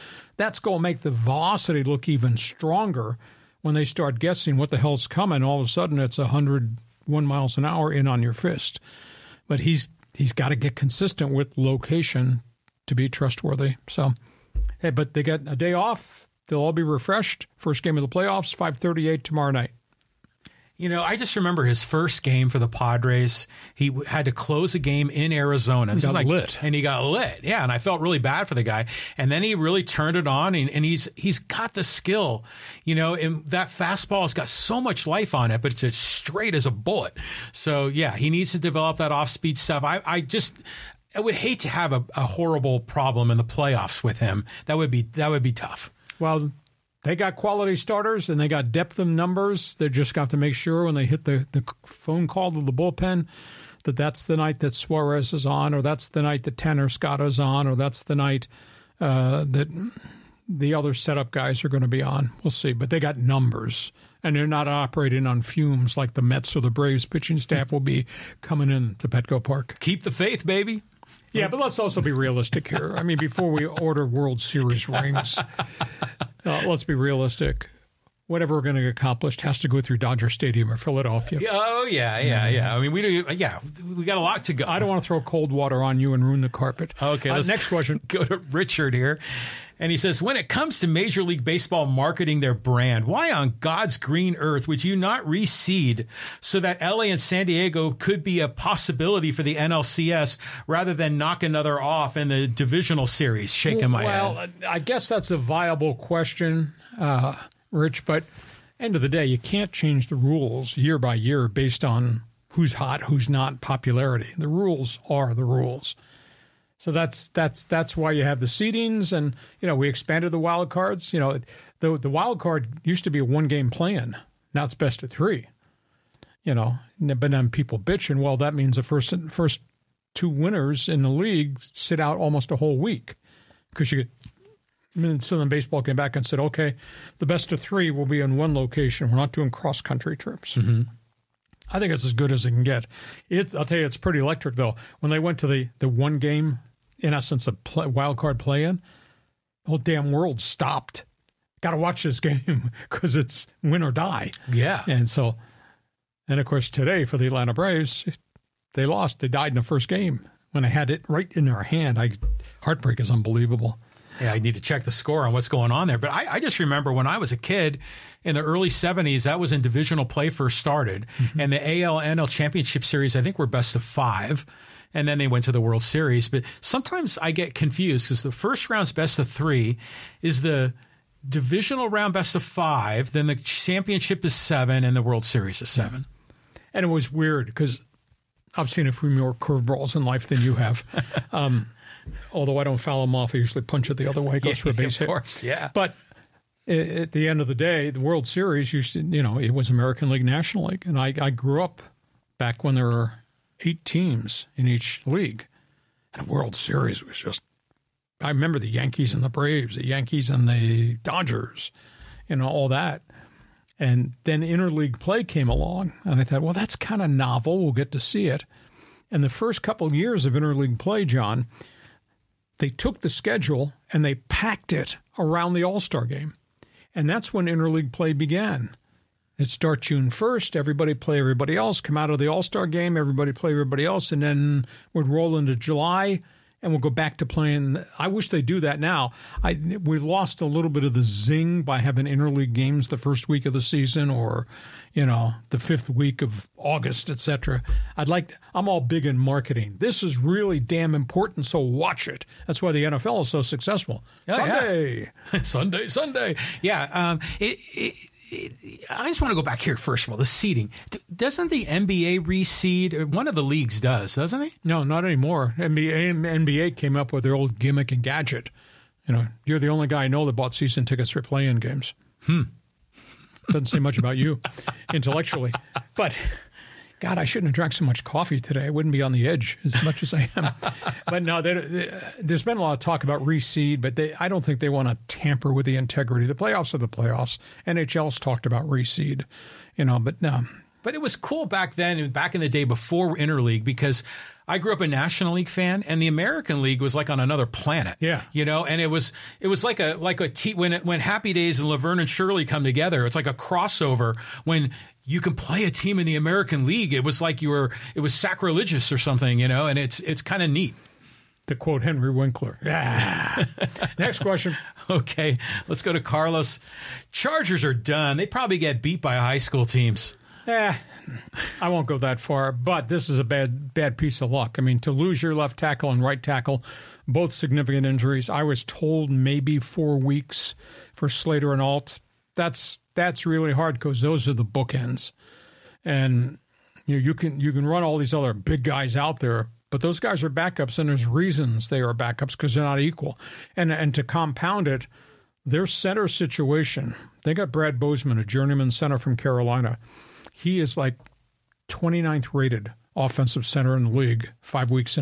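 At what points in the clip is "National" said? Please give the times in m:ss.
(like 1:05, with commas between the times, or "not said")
3:20, 4:54.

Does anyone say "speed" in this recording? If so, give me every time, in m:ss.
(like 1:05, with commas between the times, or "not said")
0:39.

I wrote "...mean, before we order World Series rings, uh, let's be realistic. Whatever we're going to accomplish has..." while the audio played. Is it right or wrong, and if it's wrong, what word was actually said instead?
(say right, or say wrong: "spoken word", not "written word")
right.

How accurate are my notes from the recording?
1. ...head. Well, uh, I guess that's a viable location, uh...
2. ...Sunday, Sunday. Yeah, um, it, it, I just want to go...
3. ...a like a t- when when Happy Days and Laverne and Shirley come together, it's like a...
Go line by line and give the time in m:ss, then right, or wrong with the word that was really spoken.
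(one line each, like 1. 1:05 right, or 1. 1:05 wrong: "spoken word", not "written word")
1. 1:44 wrong: "question", not "location"
2. 4:15 right
3. 4:59 right.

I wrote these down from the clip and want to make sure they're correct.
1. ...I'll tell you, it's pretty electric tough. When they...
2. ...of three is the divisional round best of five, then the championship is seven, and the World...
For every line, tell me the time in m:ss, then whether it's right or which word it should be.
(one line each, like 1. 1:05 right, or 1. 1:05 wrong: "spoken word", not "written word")
1. 2:23 wrong: "though", not "tough"
2. 2:59 right.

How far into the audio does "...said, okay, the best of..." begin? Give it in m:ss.
2:16.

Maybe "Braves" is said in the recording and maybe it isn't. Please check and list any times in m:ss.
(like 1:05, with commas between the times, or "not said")
1:06, 2:37, 3:29.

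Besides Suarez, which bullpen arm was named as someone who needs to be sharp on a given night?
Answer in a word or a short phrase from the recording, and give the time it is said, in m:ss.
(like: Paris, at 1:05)
Tanner Scott, at 0:56.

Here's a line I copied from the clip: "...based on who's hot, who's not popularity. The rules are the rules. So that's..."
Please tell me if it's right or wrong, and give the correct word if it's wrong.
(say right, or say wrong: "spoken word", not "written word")
right.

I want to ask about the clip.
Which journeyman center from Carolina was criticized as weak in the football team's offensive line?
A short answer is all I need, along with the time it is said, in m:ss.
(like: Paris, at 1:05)
Brad Bozeman, at 5:47.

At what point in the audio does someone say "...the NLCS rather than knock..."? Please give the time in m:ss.
1:39.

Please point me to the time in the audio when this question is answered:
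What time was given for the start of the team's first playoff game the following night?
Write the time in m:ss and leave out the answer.
0:18.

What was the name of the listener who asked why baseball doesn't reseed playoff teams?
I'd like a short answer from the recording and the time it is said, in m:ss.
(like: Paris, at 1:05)
Richard, at 1:28.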